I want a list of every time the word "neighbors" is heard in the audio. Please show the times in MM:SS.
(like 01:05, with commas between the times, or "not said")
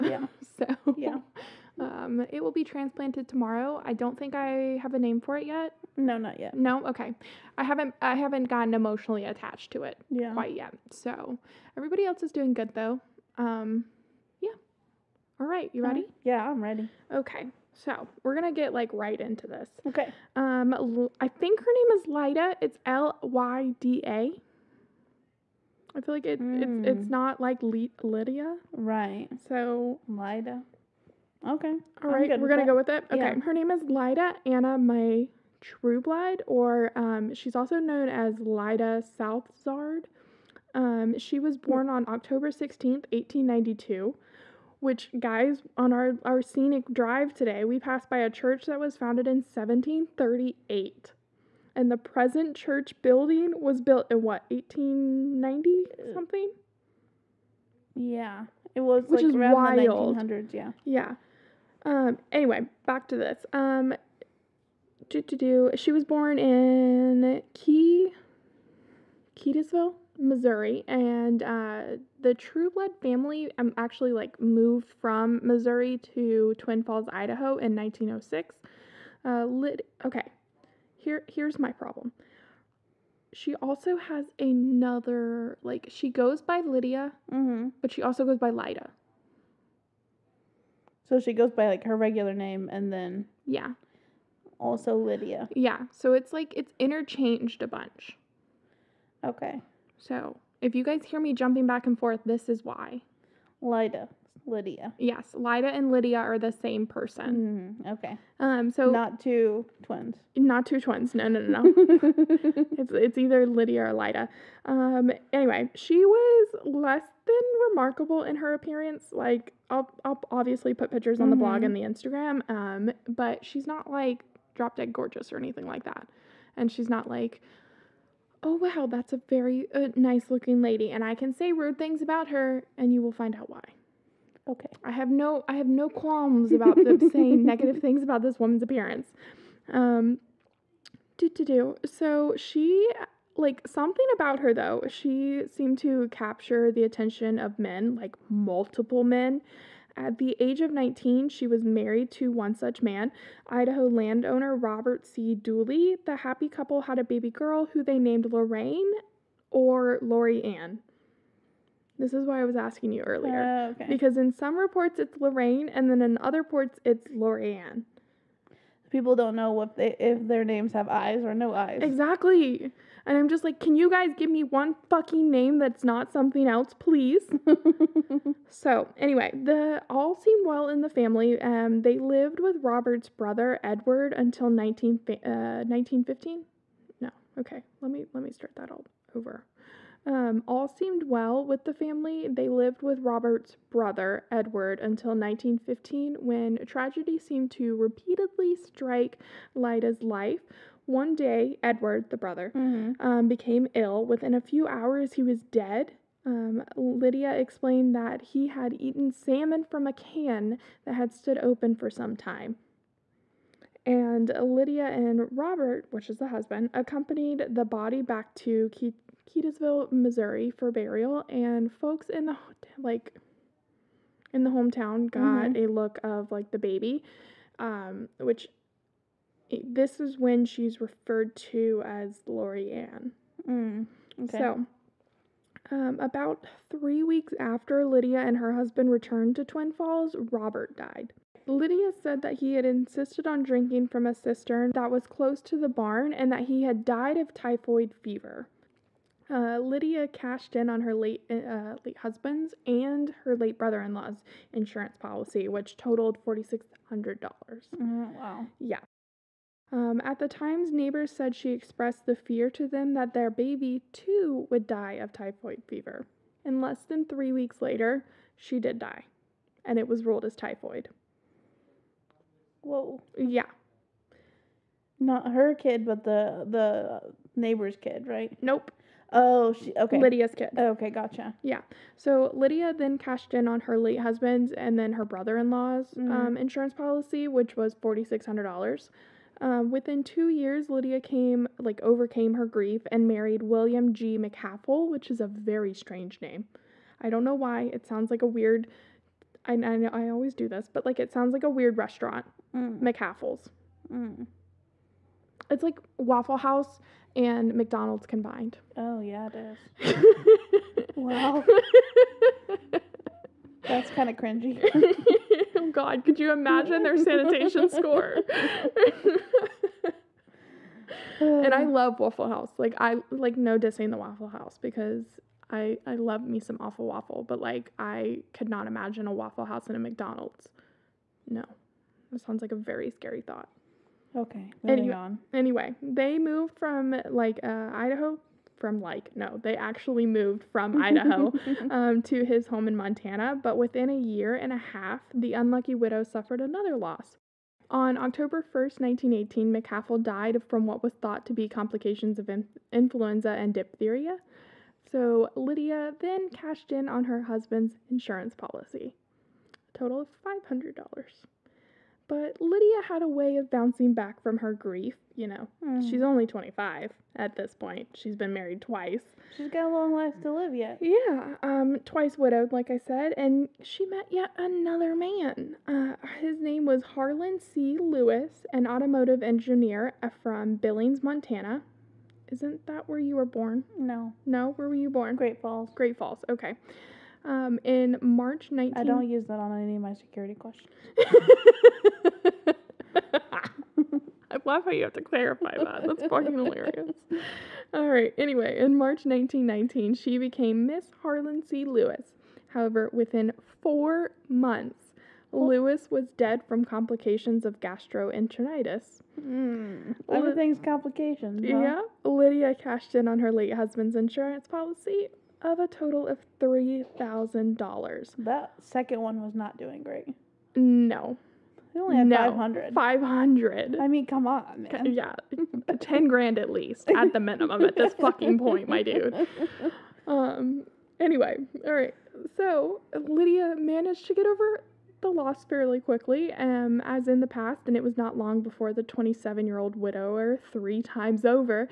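04:20, 04:37.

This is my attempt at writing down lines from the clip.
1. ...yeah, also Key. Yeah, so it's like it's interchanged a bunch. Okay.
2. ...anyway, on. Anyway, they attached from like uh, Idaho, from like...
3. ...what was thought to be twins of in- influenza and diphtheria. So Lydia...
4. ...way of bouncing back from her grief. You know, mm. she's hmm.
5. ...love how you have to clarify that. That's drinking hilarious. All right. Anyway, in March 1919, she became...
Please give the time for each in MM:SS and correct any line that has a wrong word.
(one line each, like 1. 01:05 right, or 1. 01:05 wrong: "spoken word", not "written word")
1. 01:33 wrong: "Lydia", not "Key"
2. 05:34 wrong: "moved", not "attached"
3. 05:50 wrong: "complications", not "twins"
4. 06:03 right
5. 06:34 wrong: "fucking", not "drinking".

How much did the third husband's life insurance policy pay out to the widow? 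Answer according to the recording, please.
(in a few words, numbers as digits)
$3,000.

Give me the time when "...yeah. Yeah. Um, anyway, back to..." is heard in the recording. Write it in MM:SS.
01:00.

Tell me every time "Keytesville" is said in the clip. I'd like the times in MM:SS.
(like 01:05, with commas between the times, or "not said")
01:09, 03:39.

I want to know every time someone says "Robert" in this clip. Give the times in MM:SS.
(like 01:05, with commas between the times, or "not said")
02:34, 03:02, 03:13, 03:35, 04:00.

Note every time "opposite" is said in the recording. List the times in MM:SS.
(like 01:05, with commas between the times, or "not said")
not said.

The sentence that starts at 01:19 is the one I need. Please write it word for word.
Uh, lit- okay, here here's my problem.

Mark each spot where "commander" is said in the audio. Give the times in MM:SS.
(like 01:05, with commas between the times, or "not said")
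not said.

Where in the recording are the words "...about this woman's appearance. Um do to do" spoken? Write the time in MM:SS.
02:18.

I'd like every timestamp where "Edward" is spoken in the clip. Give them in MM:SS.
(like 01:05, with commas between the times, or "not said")
03:03, 03:14, 03:21.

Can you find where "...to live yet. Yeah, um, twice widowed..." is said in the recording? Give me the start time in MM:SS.
06:10.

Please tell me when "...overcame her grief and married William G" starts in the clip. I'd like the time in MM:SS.
04:51.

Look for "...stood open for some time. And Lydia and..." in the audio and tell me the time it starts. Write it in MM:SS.
03:31.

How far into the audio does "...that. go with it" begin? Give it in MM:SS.
00:32.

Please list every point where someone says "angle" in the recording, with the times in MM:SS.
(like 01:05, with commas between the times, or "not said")
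not said.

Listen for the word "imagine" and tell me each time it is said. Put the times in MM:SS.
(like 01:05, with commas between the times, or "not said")
05:16, 05:28.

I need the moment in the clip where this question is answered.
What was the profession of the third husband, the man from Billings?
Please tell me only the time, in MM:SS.
06:18.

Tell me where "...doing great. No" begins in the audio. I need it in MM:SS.
06:59.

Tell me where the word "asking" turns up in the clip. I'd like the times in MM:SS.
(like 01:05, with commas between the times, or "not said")
02:42.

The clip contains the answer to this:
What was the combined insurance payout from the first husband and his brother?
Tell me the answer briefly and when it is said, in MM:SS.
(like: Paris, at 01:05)
$4,600, at 04:16.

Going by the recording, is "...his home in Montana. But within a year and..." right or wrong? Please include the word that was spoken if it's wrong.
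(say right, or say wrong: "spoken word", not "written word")
right.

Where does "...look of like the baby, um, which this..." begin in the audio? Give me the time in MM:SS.
03:45.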